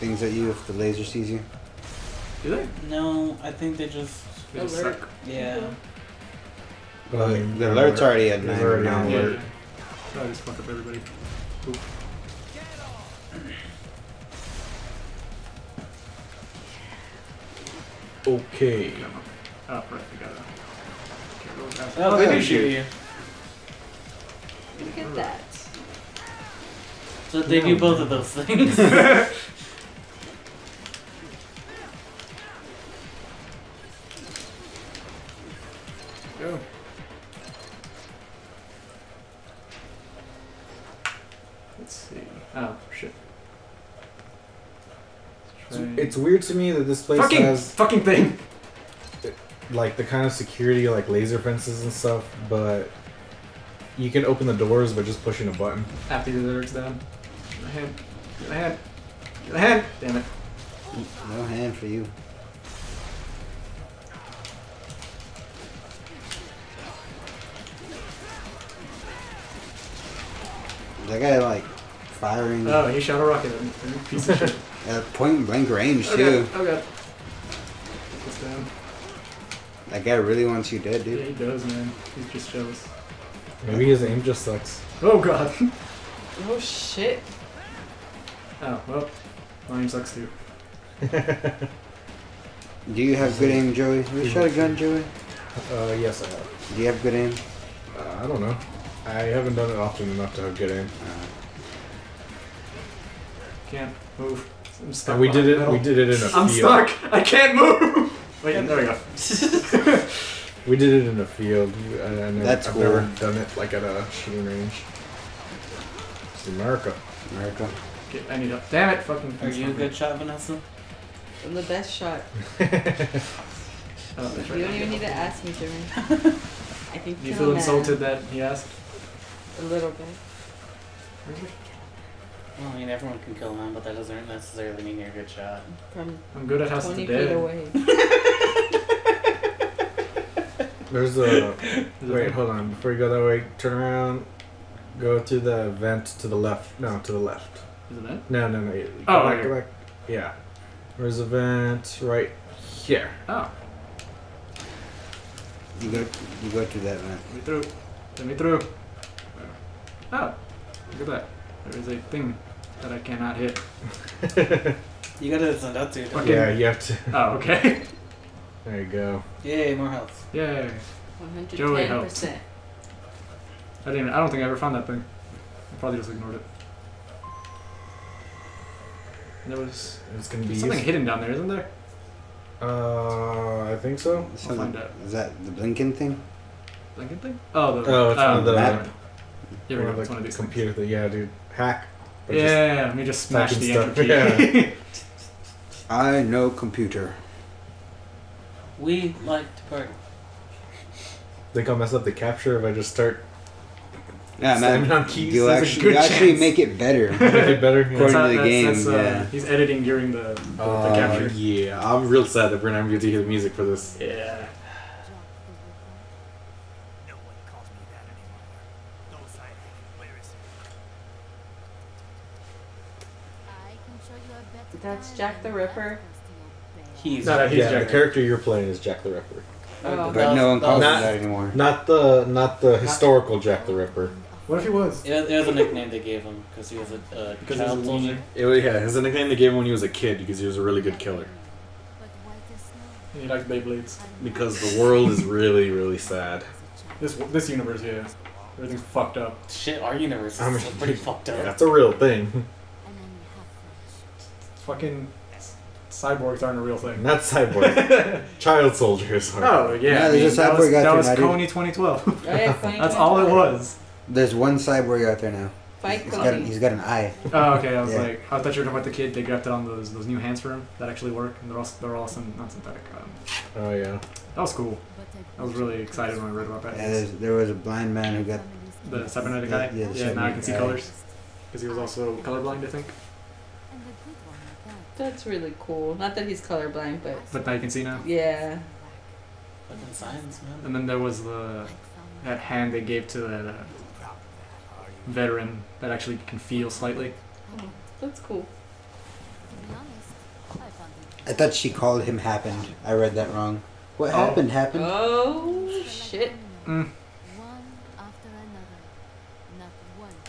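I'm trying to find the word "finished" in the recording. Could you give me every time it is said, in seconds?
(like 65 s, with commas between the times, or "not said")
not said.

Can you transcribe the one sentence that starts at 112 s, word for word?
never done it like at a shooting range.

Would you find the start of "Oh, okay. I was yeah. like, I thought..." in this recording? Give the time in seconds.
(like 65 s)
267 s.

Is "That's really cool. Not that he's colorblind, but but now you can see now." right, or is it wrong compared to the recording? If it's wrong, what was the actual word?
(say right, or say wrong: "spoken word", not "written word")
right.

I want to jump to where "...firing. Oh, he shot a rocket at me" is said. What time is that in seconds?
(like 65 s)
71 s.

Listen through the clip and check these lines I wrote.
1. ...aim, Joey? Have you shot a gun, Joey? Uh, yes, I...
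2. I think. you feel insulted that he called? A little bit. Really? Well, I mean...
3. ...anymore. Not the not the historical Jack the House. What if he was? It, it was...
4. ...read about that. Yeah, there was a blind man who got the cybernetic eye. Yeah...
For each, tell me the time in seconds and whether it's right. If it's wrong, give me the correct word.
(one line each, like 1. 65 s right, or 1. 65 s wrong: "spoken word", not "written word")
1. 93 s right
2. 125 s wrong: "asked", not "called"
3. 231 s wrong: "Ripper", not "House"
4. 276 s right.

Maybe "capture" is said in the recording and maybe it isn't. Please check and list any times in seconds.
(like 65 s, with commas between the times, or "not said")
202 s, 210 s.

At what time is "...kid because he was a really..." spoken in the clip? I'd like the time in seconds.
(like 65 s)
239 s.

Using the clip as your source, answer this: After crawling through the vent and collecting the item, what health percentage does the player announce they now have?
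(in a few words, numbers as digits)
110 percent.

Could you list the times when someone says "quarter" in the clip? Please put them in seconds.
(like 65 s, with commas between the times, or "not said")
not said.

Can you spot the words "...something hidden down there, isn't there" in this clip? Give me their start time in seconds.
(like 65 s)
180 s.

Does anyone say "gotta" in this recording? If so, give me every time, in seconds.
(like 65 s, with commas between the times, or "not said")
20 s, 165 s.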